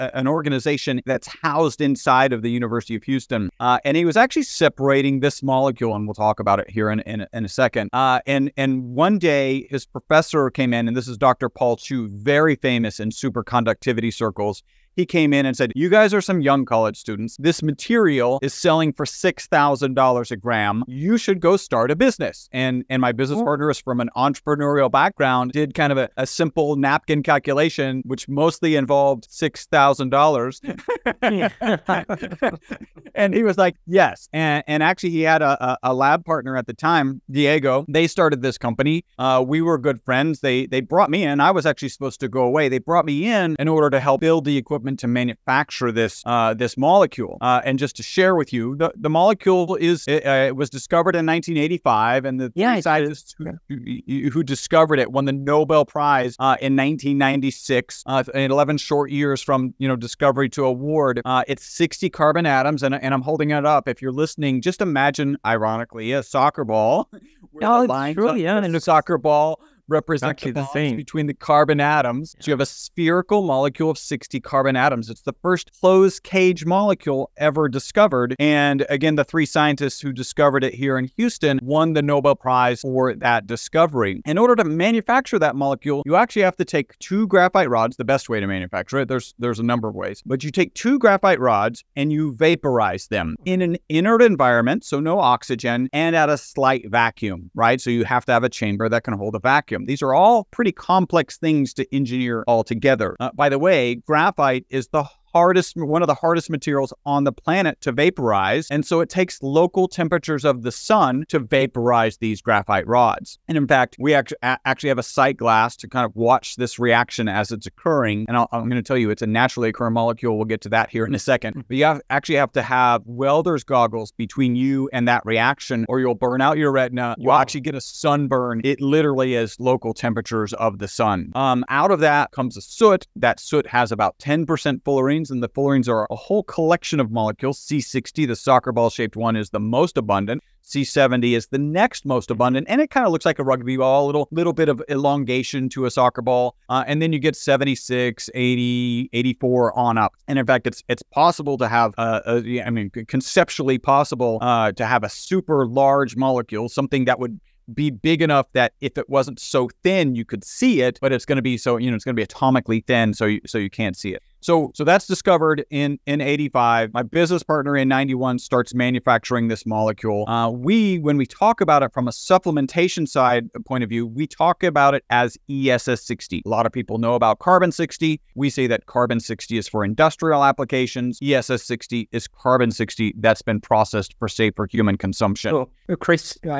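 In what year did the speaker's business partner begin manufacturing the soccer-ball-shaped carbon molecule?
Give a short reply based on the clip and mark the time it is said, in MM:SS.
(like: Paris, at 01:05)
1991, at 02:47.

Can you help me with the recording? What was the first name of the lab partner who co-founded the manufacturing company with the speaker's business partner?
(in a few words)
Diego.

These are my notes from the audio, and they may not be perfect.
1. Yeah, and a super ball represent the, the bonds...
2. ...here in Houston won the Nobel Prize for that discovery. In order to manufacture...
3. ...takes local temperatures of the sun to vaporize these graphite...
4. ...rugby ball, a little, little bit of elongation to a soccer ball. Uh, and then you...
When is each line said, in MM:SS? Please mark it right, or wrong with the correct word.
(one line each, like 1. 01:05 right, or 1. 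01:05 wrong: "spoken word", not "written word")
1. 01:08 wrong: "soccer", not "super"
2. 01:20 right
3. 01:49 right
4. 02:23 right.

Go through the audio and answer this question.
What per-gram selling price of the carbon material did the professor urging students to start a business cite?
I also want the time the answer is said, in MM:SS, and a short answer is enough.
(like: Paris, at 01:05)
$6,000, at 00:19.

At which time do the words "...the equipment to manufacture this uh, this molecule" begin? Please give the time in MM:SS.
00:44.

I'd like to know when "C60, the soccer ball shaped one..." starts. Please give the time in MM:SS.
02:17.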